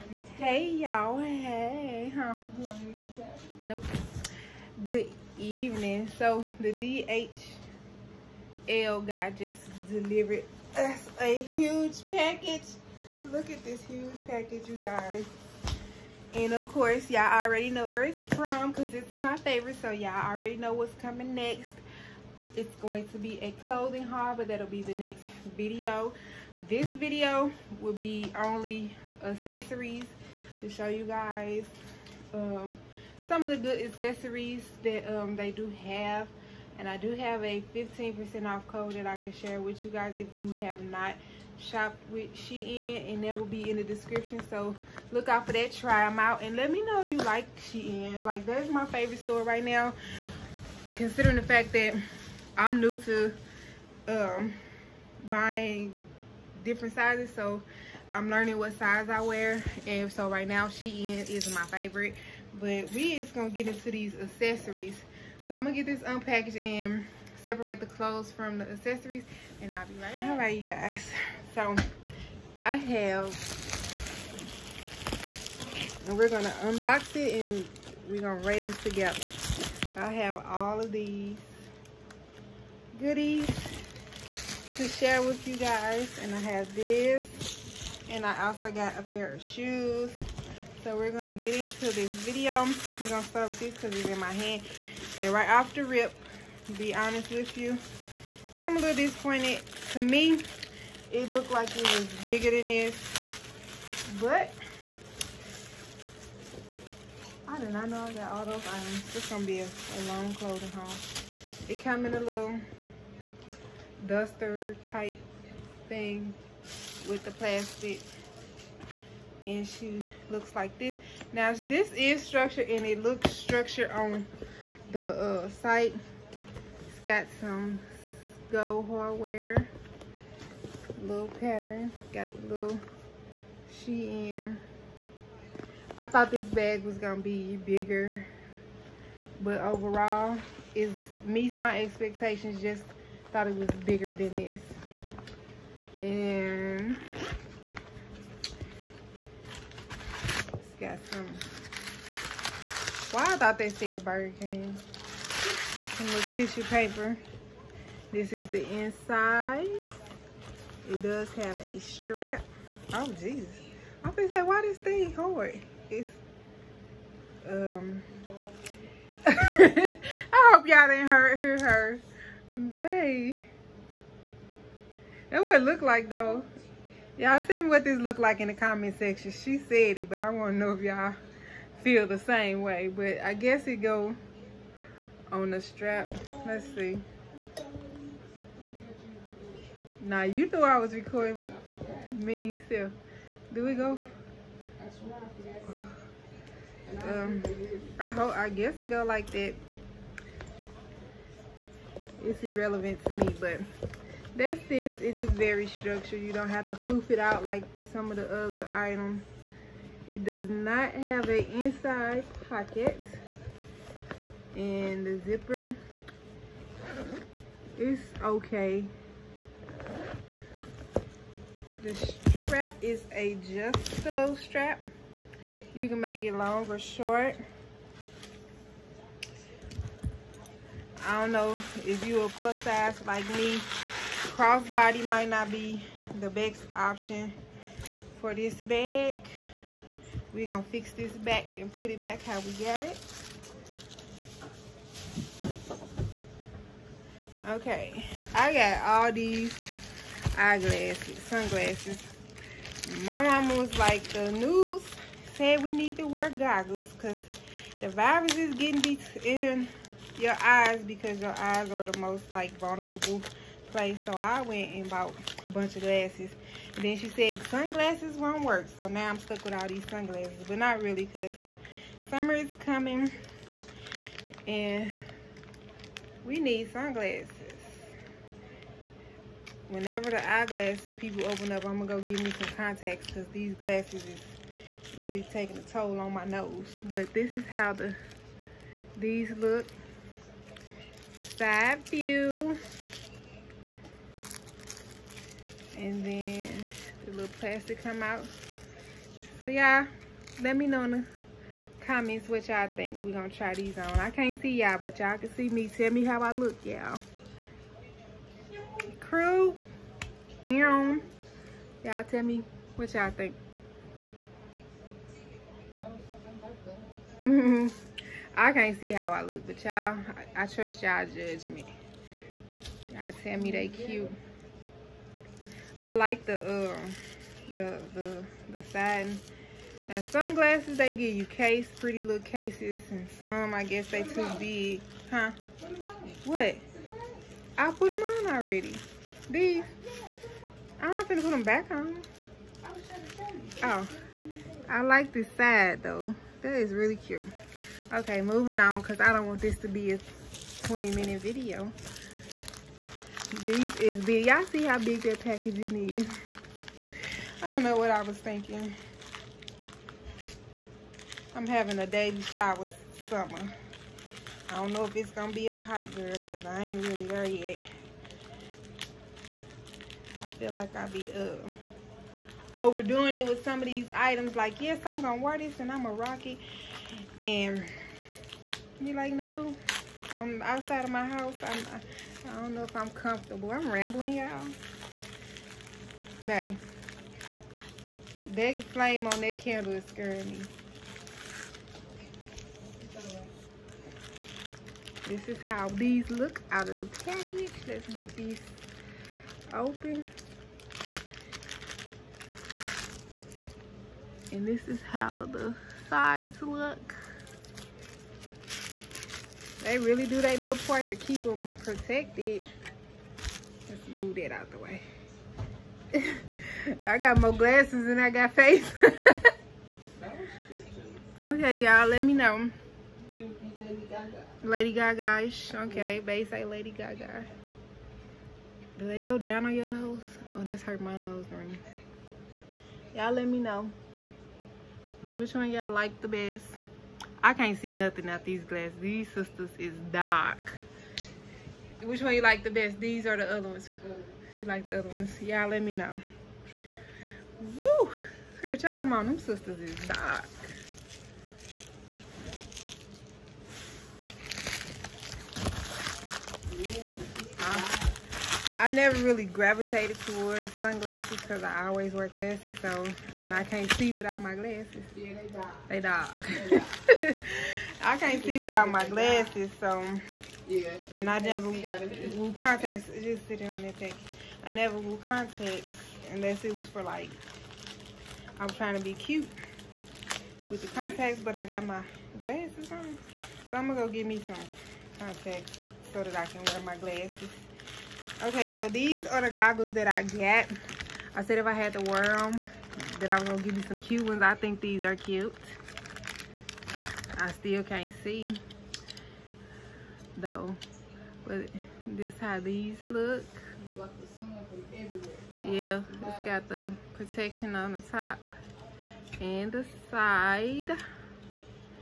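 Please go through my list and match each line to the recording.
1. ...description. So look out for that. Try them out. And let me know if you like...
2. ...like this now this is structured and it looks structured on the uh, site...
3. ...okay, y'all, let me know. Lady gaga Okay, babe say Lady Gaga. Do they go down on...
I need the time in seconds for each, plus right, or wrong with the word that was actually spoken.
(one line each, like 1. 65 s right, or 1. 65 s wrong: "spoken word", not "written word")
1. 43 s right
2. 120 s right
3. 421 s right.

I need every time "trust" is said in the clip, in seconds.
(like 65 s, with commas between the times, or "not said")
320 s.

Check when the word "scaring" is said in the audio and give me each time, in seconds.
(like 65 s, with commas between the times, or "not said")
389 s.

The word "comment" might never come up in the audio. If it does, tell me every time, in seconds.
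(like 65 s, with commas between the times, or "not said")
178 s, 301 s.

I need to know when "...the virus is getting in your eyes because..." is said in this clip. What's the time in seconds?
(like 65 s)
257 s.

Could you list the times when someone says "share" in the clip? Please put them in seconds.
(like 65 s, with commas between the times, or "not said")
39 s, 84 s.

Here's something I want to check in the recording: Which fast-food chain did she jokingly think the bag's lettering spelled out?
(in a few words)
Burger King.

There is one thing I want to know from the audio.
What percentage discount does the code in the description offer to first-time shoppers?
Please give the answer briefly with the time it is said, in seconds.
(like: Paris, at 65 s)
15%, at 37 s.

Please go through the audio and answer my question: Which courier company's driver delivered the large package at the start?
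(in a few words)
DHL.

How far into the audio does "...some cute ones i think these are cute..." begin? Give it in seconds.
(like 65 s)
493 s.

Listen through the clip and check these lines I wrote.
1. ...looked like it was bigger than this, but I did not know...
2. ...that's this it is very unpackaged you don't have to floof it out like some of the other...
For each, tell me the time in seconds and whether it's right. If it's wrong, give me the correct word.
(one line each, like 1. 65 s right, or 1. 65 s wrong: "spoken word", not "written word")
1. 101 s right
2. 204 s wrong: "structured", not "unpackaged".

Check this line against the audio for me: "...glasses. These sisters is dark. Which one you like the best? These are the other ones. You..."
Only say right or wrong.
right.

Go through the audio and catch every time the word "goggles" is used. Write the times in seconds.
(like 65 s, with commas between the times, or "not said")
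256 s, 489 s.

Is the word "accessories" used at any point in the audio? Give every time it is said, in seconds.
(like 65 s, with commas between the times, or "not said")
29 s, 33 s, 64 s, 68 s.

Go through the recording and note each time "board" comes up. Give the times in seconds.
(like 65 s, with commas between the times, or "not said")
not said.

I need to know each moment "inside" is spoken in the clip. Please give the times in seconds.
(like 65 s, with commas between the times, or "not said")
158 s, 211 s.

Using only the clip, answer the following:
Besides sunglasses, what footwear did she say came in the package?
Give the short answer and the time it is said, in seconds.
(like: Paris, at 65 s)
shoes, at 88 s.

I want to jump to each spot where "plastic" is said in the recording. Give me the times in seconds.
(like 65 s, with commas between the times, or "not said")
117 s, 297 s.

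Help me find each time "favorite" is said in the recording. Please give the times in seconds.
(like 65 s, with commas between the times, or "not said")
19 s, 48 s, 61 s.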